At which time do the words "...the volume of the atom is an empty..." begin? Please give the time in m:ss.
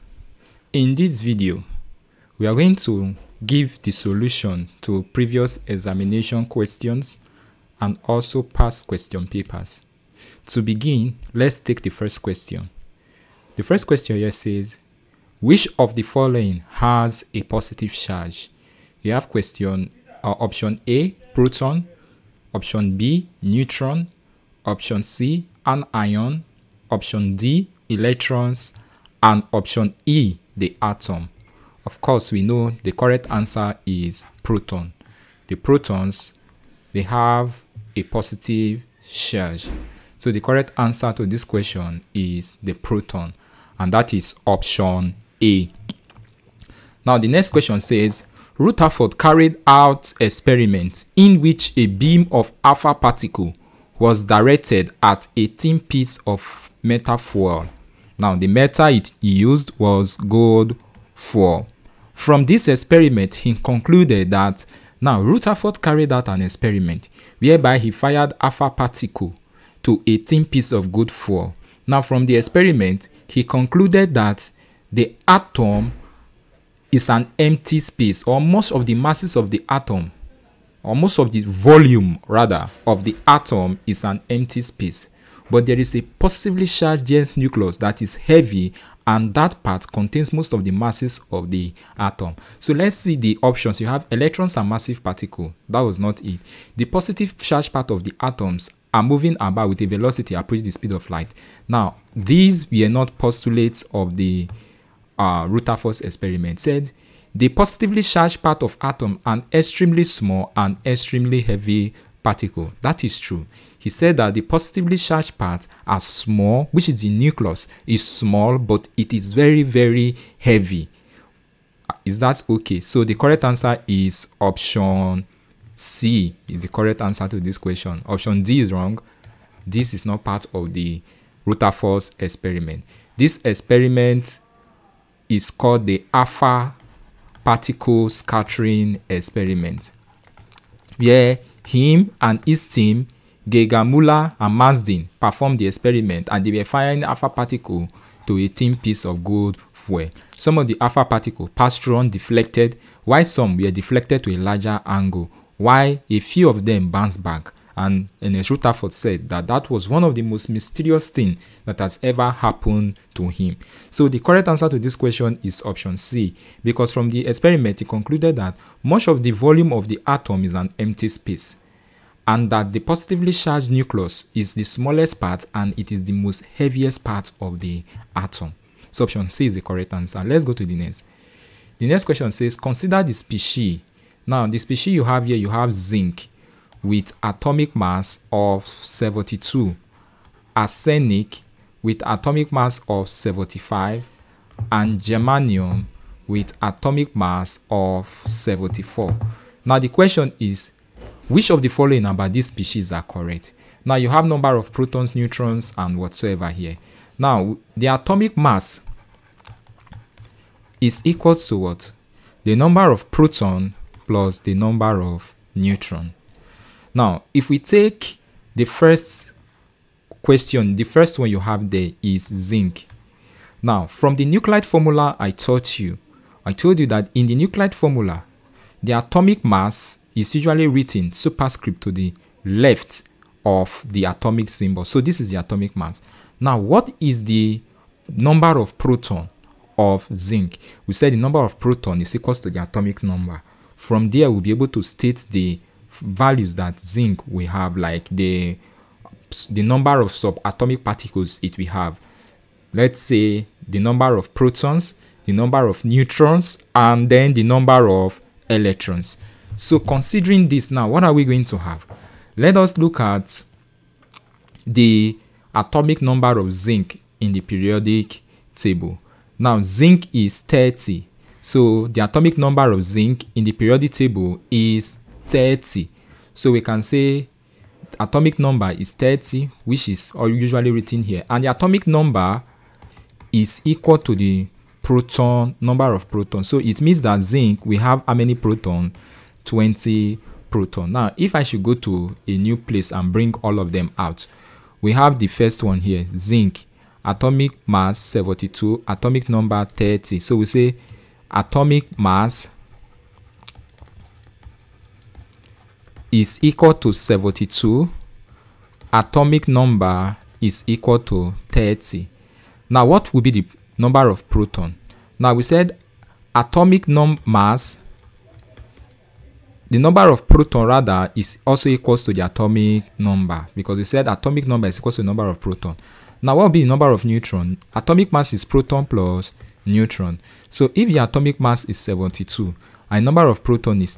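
2:49.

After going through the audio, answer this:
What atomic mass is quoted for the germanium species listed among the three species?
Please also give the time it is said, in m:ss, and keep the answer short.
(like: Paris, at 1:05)
74, at 3:16.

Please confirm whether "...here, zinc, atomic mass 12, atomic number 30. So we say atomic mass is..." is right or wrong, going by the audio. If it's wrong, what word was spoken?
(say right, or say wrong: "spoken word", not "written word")
wrong: "72", not "12".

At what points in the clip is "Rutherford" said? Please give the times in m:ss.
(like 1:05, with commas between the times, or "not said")
0:48, 1:05, 1:45, 2:11, 2:38.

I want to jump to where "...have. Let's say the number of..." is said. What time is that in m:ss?
4:11.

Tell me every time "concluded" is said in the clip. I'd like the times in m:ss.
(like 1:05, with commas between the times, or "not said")
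1:03, 1:13, 2:47.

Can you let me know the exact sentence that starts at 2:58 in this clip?
So option C is the correct answer.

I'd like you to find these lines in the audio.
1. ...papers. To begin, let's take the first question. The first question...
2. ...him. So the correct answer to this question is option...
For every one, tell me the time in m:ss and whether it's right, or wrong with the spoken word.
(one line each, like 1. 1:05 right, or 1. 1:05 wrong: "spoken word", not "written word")
1. 0:09 right
2. 2:43 right.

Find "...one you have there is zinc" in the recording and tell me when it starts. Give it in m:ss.
3:41.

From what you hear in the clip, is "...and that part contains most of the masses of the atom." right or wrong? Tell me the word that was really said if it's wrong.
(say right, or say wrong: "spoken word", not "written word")
right.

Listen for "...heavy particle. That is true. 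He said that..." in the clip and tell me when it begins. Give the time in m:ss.
1:51.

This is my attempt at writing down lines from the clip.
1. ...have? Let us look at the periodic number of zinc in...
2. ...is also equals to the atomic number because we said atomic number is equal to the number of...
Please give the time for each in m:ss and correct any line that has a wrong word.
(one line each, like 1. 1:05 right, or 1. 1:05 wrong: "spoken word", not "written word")
1. 4:21 wrong: "atomic", not "periodic"
2. 5:21 right.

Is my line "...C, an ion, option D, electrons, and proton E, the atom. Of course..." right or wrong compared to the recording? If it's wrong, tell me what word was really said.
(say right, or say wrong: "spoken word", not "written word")
wrong: "option", not "proton".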